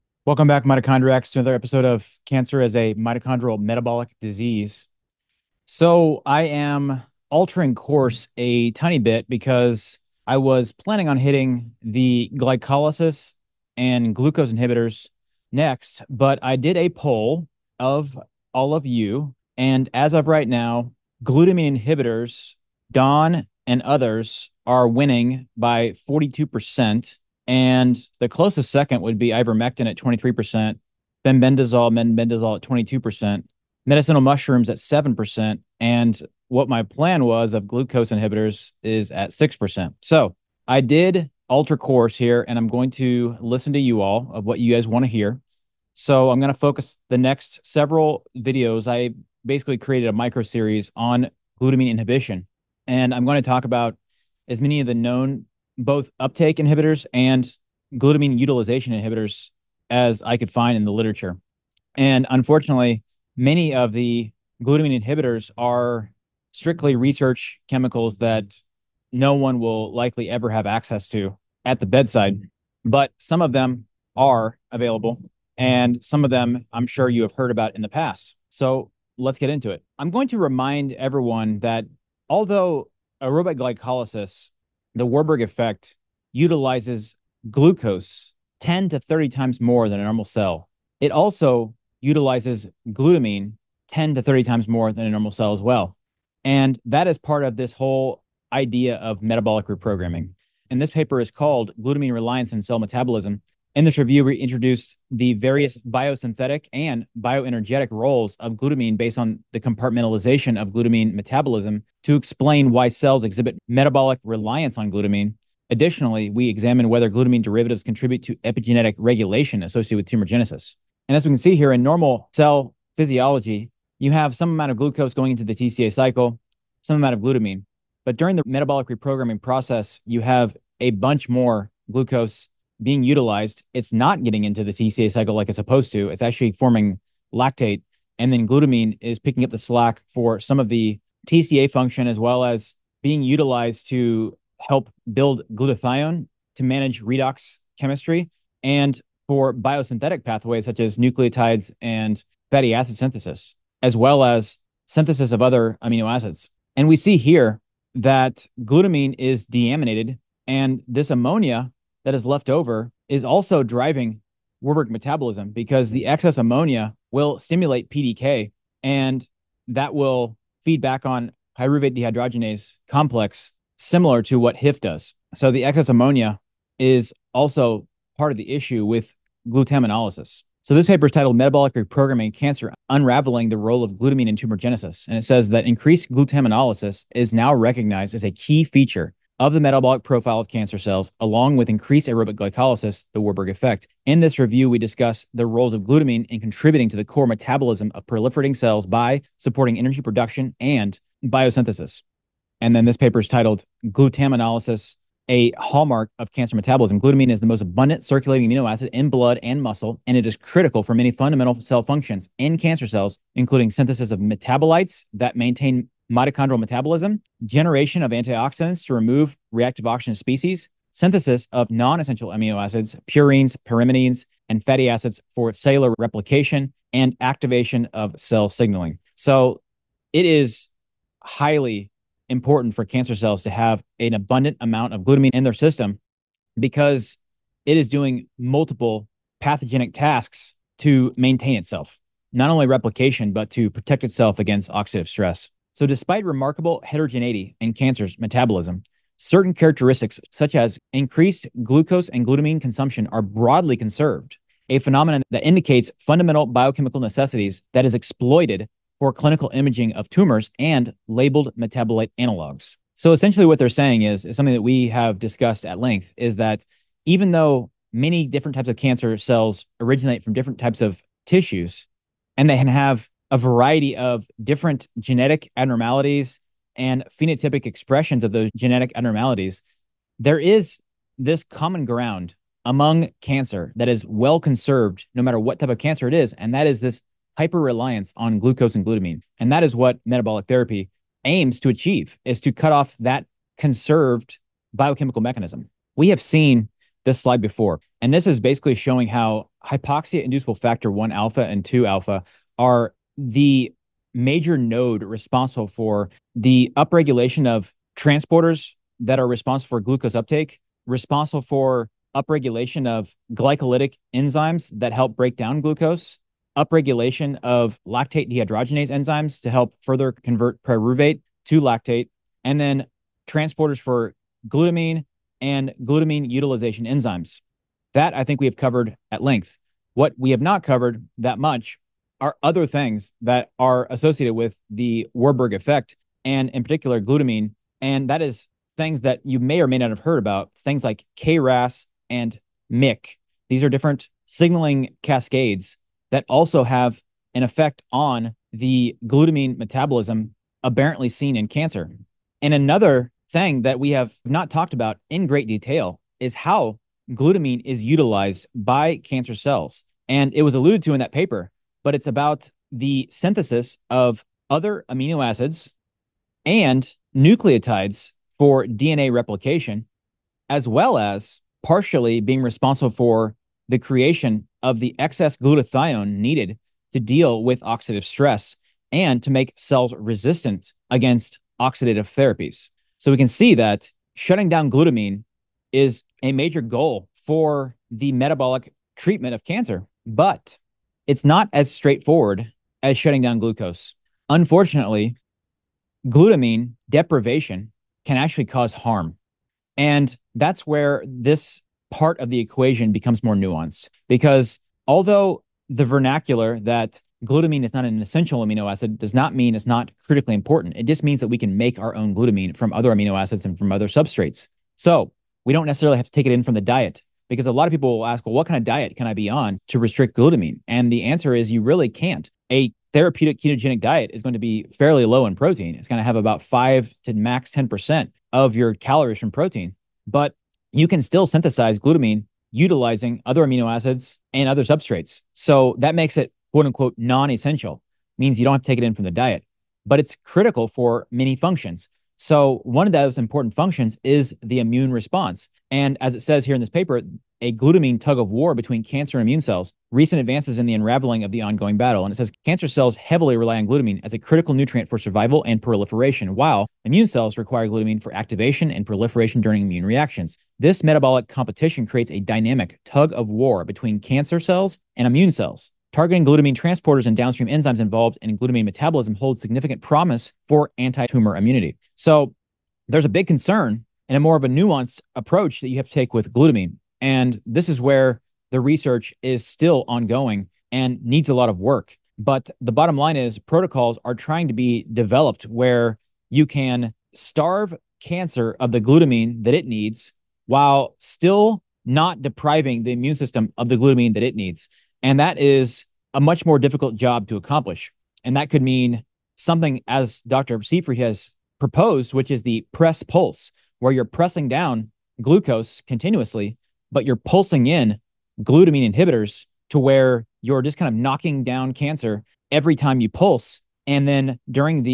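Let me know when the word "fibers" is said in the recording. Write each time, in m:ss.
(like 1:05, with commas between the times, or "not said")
not said.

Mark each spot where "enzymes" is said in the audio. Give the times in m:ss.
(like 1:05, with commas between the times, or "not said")
5:14, 5:18, 5:26, 7:47.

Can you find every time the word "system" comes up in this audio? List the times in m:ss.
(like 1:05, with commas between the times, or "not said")
3:55, 8:13.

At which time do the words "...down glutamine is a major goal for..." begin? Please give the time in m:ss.
6:24.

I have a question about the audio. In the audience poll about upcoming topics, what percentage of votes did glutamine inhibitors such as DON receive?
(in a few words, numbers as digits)
42%.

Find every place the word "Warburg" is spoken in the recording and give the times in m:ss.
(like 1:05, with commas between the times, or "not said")
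1:25, 2:44, 3:13, 5:35.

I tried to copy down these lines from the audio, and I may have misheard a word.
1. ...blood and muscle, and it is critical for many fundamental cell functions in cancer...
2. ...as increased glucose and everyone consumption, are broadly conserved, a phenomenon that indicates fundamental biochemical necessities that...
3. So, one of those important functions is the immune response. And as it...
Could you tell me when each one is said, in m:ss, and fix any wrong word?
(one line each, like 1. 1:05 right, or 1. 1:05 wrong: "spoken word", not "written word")
1. 3:29 right
2. 4:10 wrong: "glutamine", not "everyone"
3. 7:22 right.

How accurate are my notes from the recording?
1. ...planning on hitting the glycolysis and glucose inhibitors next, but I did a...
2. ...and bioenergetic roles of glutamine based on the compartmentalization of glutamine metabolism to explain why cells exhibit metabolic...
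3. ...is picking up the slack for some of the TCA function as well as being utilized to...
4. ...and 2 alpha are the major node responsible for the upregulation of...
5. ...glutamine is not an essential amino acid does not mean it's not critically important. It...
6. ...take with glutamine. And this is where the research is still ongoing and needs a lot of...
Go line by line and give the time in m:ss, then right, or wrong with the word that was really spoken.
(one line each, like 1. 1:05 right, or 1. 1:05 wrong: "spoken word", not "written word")
1. 0:10 right
2. 1:46 right
3. 2:19 right
4. 5:01 right
5. 6:47 right
6. 7:55 right.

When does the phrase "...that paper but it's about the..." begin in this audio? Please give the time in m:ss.
6:00.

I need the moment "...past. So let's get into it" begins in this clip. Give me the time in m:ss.
1:17.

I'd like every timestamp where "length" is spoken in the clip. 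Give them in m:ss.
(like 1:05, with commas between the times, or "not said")
4:25, 5:29.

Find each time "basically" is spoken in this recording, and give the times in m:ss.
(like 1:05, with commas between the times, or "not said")
0:49, 4:58.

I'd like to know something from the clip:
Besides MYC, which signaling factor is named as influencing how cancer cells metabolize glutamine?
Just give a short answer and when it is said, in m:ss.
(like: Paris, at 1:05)
KRAS, at 5:41.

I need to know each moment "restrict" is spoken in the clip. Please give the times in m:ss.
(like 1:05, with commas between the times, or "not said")
6:59.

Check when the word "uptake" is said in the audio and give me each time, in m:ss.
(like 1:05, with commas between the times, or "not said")
0:56, 5:10.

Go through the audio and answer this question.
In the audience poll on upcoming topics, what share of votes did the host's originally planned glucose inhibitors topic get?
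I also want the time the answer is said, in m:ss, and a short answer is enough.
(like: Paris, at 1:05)
6%, at 0:39.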